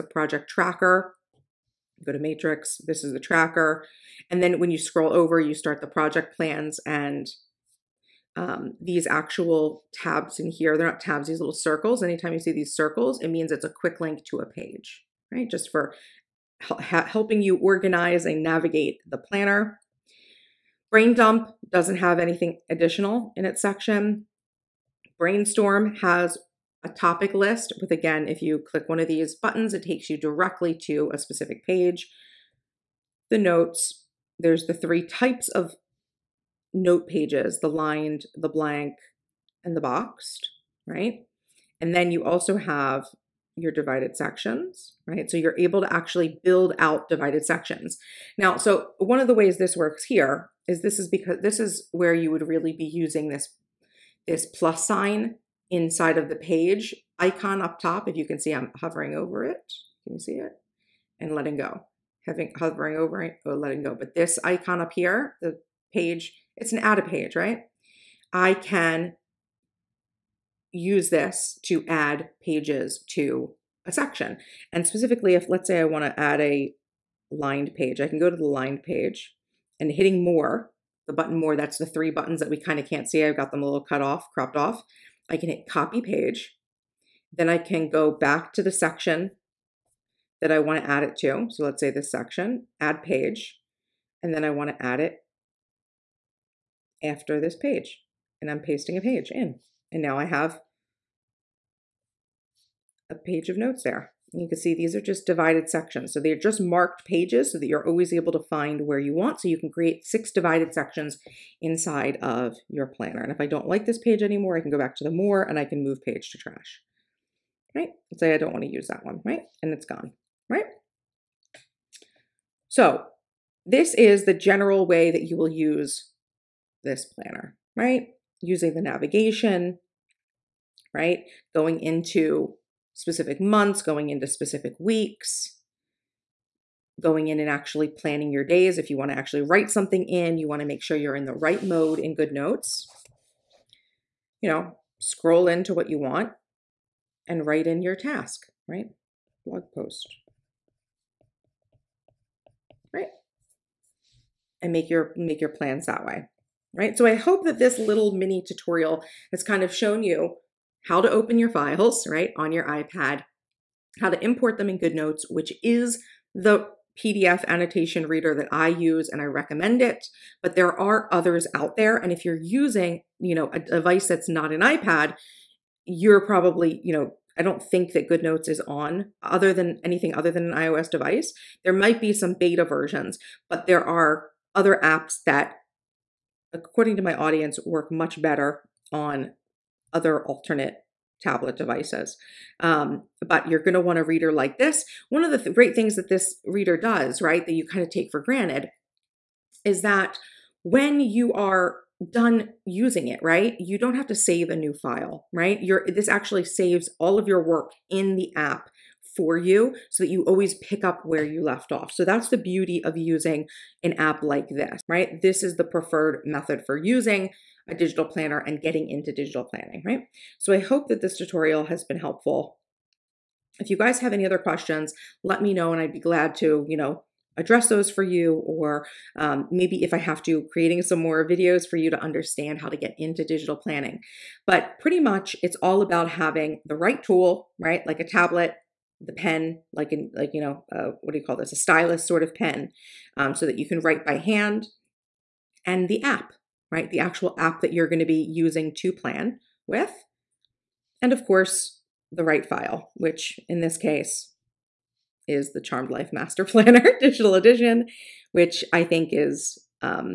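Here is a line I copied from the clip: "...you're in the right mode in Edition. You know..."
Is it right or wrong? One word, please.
wrong.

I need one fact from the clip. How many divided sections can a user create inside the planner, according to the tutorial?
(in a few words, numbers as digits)
6.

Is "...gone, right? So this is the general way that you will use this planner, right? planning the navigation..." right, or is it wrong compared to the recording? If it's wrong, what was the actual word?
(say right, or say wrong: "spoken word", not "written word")
wrong: "using", not "planning".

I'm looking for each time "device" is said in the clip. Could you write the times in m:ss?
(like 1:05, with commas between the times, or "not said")
2:53, 3:00, 3:11.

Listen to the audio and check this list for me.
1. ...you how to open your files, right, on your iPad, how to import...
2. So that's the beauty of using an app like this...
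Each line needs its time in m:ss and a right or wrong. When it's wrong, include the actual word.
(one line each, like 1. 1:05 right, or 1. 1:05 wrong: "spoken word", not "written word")
1. 2:40 right
2. 3:31 right.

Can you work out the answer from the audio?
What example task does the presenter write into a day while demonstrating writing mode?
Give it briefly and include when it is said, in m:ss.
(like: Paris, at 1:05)
Blog post, at 2:29.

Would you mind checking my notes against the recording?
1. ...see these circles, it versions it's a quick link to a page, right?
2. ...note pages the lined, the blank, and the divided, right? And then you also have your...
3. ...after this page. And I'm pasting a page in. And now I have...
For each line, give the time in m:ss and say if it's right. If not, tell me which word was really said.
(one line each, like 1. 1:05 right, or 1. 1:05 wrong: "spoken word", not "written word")
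1. 0:12 wrong: "means", not "versions"
2. 0:36 wrong: "boxed", not "divided"
3. 1:37 right.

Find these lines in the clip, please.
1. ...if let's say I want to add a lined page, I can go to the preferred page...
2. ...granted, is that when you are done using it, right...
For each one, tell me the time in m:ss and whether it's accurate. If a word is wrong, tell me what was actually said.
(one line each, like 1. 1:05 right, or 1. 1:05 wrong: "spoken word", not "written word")
1. 1:15 wrong: "lined", not "preferred"
2. 3:18 right.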